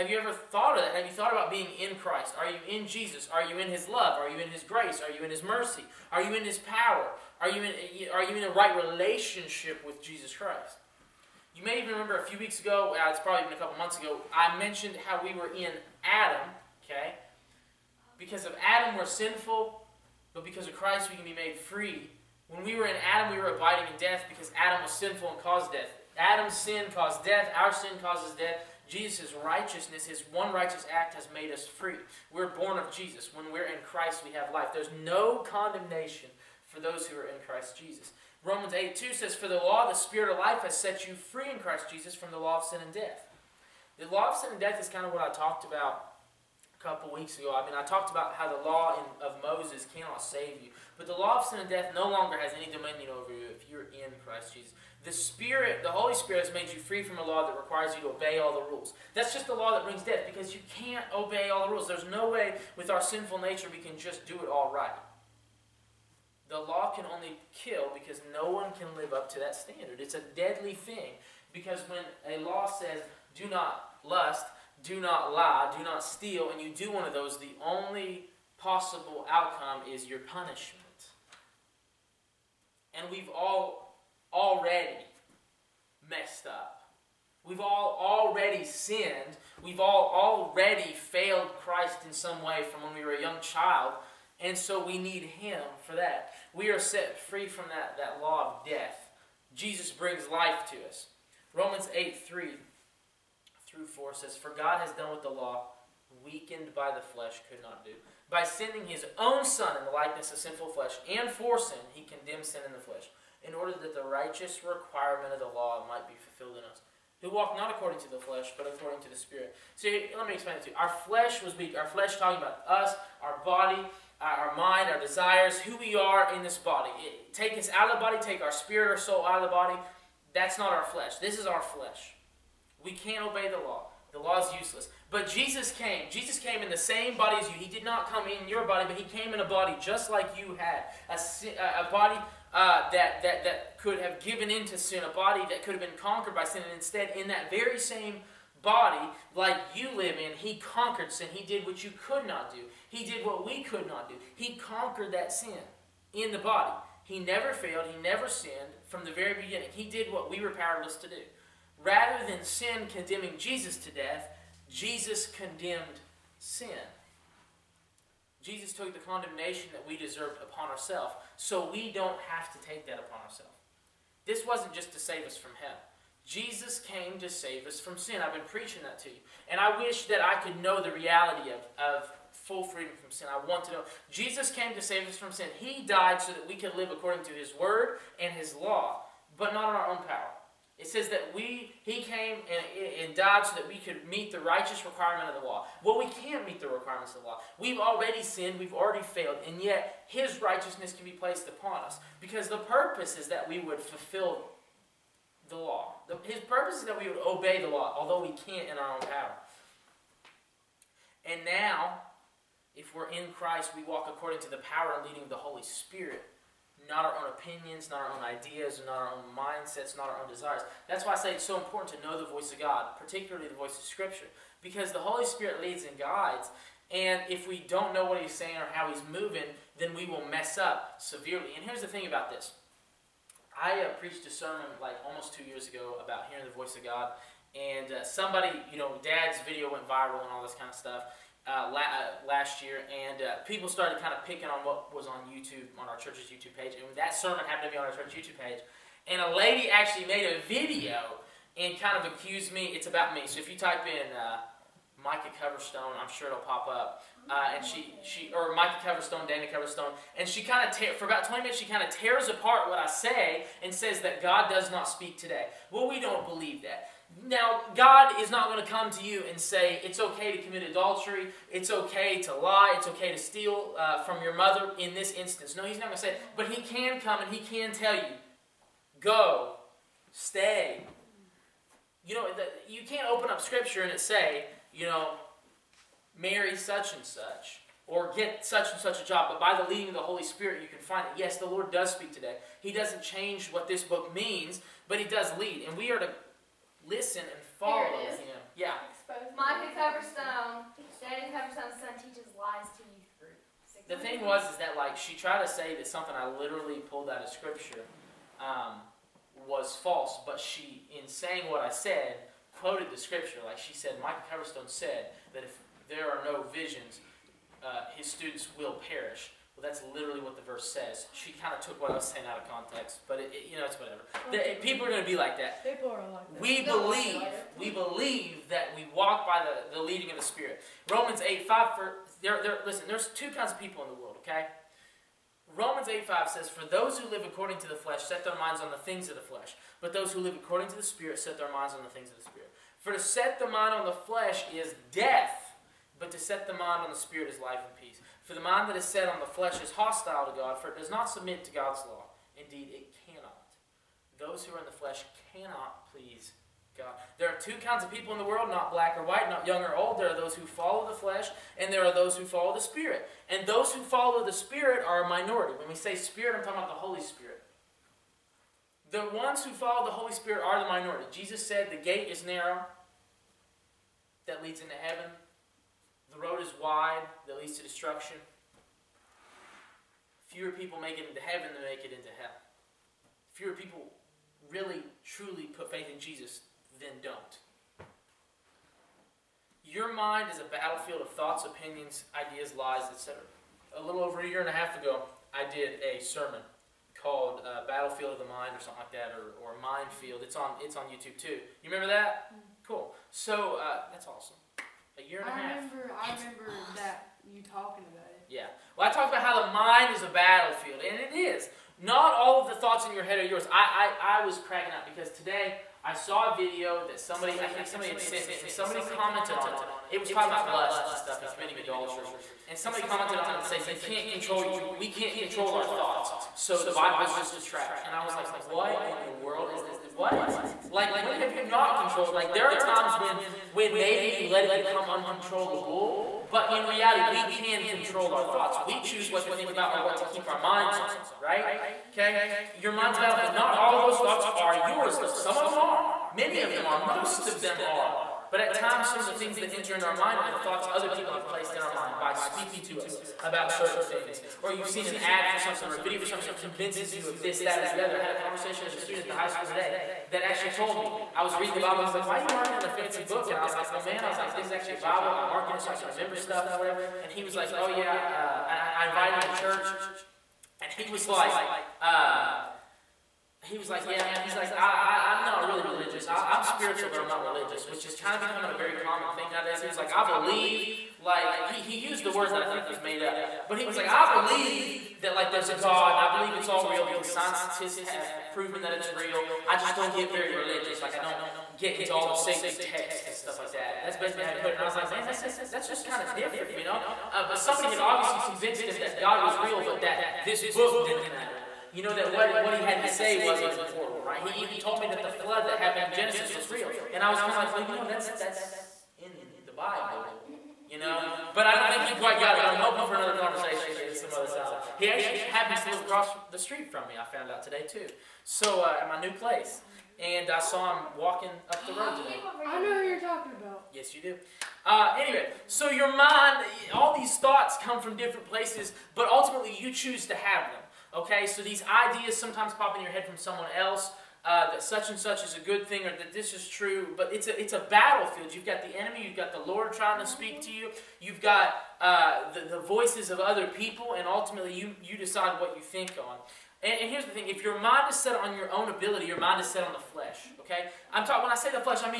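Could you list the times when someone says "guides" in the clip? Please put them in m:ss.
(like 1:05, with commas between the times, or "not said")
3:45.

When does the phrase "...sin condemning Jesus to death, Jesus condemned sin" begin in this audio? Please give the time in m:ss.
2:42.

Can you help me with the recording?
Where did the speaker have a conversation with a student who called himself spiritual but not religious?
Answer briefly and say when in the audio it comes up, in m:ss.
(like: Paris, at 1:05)
The high school, at 7:39.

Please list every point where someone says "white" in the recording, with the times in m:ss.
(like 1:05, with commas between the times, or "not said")
5:59.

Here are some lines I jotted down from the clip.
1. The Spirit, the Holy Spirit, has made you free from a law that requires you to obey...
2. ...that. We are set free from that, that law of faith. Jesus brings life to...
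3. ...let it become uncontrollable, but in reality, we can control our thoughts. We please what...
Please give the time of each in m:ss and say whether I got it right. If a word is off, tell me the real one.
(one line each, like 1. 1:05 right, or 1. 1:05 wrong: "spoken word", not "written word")
1. 0:55 right
2. 1:35 wrong: "death", not "faith"
3. 7:14 wrong: "choose", not "please".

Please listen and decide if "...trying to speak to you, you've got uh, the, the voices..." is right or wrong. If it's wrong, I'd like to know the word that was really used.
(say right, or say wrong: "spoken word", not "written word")
right.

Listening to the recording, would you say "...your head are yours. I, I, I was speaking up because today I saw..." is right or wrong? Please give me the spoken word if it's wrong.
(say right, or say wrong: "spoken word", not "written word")
wrong: "cracking", not "speaking".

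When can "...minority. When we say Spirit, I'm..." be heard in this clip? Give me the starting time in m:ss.
6:05.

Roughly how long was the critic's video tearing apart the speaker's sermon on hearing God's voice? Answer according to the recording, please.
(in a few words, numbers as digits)
About 20 minutes.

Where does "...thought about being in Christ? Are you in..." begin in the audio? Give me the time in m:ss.
0:01.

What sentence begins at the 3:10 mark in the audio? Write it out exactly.
It says that we, he came and, and, died so that we could meet the righteous requirement of the law.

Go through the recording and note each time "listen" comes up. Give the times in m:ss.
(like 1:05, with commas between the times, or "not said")
4:56, 5:32.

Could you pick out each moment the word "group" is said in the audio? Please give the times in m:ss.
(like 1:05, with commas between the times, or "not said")
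5:03.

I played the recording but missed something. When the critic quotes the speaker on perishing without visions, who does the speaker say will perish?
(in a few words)
His students.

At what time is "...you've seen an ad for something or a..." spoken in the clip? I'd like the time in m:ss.
7:34.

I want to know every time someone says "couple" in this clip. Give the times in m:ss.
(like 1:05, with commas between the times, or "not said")
0:13, 0:46.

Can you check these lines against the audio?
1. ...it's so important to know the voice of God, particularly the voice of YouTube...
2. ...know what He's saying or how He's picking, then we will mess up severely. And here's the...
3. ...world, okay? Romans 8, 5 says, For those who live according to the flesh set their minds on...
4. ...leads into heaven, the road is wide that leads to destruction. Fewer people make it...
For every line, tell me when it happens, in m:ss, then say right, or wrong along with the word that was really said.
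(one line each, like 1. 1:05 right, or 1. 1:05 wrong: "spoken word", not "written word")
1. 3:41 wrong: "Scripture", not "YouTube"
2. 3:47 wrong: "moving", not "picking"
3. 5:33 right
4. 6:14 right.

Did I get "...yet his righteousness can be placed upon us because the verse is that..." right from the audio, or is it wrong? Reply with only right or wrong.
wrong.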